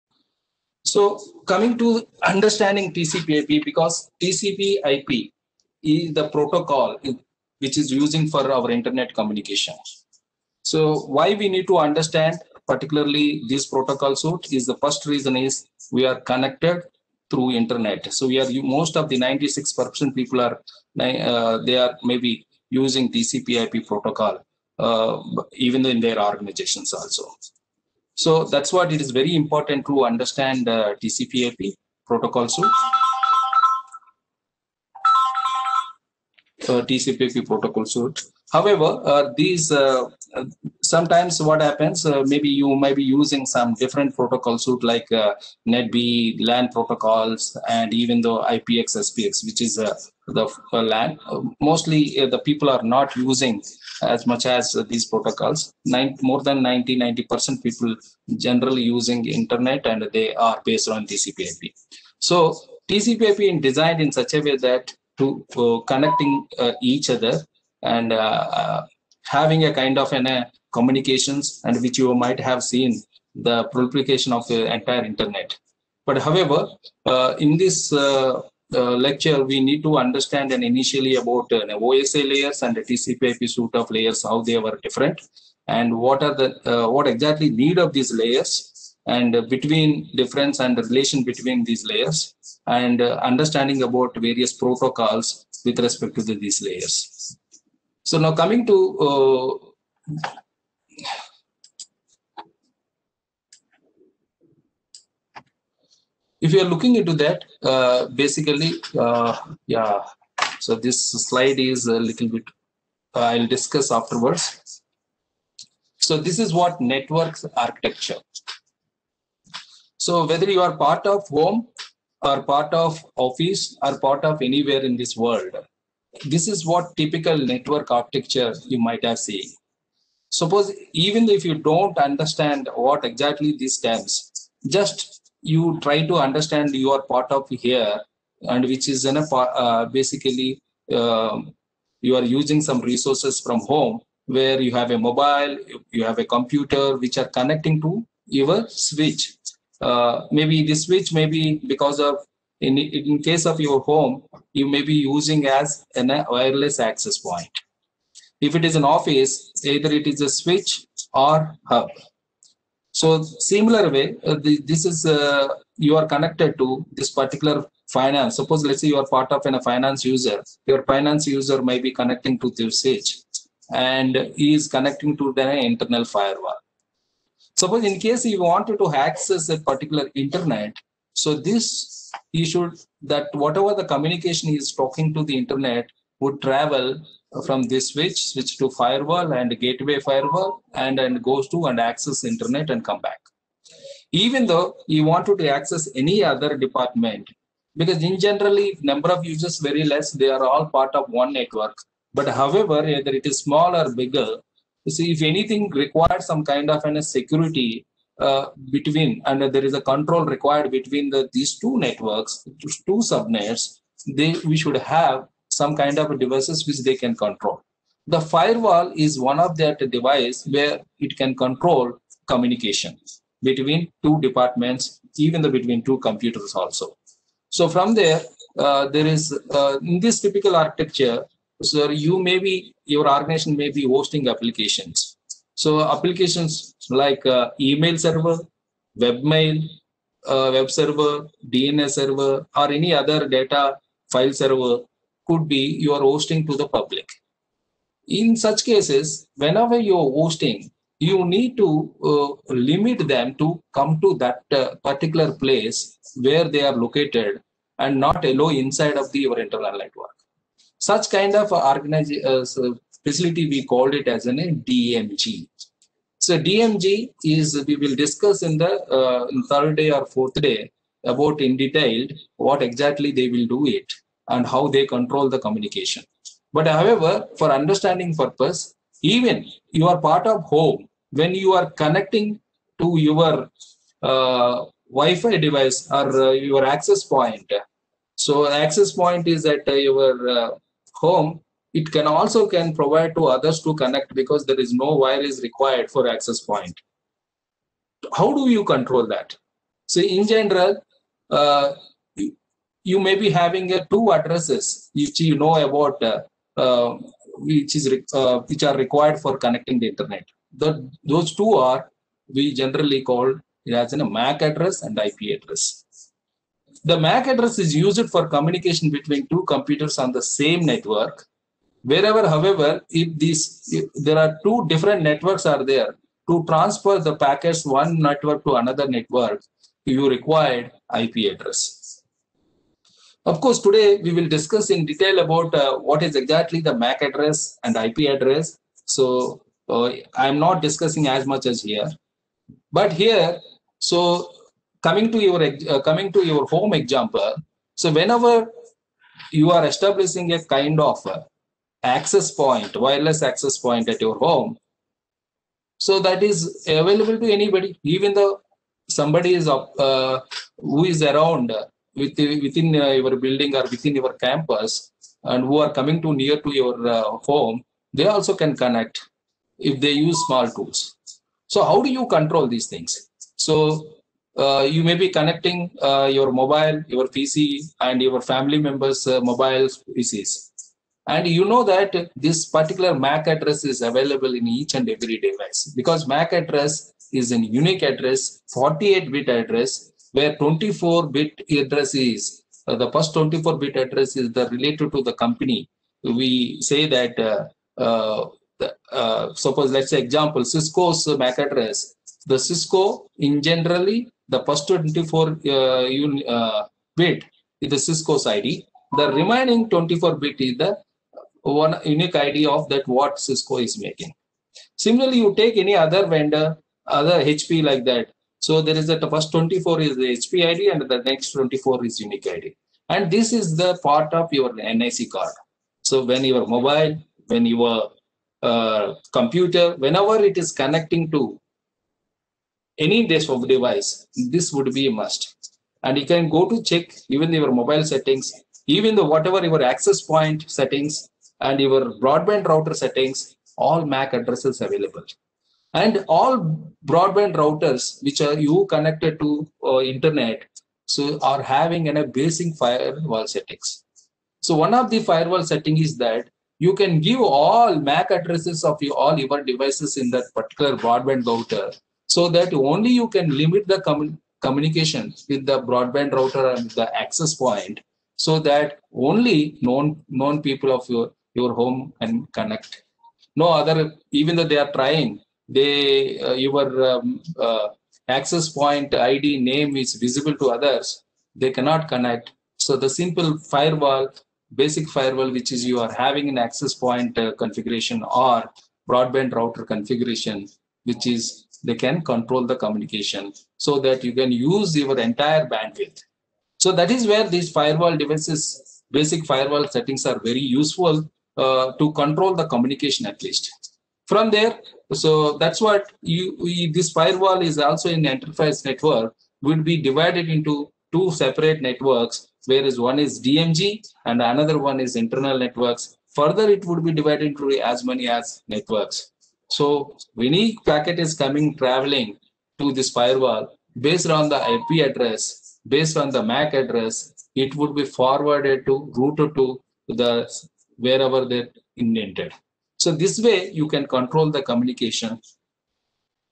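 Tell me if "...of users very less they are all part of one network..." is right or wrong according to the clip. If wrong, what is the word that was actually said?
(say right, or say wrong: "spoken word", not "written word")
right.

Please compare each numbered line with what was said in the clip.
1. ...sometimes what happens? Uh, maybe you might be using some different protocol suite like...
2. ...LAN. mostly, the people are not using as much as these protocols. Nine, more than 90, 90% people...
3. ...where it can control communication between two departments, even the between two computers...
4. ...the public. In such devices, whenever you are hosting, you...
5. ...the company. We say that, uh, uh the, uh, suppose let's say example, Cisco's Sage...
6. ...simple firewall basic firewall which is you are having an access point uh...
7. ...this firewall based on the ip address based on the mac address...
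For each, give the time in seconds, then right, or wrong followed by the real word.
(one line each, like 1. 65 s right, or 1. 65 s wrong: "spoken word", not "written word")
1. 40 s right
2. 50 s right
3. 220 s right
4. 246 s wrong: "cases", not "devices"
5. 395 s wrong: "MAC", not "Sage"
6. 483 s right
7. 522 s right.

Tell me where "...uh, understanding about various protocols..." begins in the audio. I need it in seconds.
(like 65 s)
93 s.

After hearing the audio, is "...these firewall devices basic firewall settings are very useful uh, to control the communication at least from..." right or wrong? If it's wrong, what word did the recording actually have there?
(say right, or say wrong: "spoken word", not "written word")
right.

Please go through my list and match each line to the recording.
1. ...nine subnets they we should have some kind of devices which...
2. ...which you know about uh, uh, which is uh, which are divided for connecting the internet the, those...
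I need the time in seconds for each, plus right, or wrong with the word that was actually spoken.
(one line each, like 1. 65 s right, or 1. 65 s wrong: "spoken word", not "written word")
1. 212 s wrong: "two", not "nine"
2. 304 s wrong: "required", not "divided".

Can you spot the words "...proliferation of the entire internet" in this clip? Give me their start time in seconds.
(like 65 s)
73 s.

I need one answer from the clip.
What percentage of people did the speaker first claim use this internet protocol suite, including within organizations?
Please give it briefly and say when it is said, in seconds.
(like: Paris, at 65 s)
96%, at 19 s.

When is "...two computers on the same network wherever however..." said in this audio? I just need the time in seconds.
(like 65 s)
319 s.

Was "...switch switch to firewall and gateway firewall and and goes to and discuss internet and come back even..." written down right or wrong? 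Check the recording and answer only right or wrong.
wrong.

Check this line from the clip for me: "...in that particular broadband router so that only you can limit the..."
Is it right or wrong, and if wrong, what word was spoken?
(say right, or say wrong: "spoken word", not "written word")
right.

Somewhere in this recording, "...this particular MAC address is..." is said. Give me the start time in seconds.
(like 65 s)
382 s.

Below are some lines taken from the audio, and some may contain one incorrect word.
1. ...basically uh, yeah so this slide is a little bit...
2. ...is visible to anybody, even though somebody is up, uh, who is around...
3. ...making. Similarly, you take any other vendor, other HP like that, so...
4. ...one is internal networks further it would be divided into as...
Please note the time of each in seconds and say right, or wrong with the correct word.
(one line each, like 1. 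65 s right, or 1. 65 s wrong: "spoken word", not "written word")
1. 108 s right
2. 356 s wrong: "available", not "visible"
3. 413 s right
4. 514 s right.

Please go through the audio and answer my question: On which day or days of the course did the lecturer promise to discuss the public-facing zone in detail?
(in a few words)
third day or fourth day.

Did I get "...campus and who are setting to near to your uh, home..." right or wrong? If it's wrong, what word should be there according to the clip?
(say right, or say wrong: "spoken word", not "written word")
wrong: "coming", not "setting".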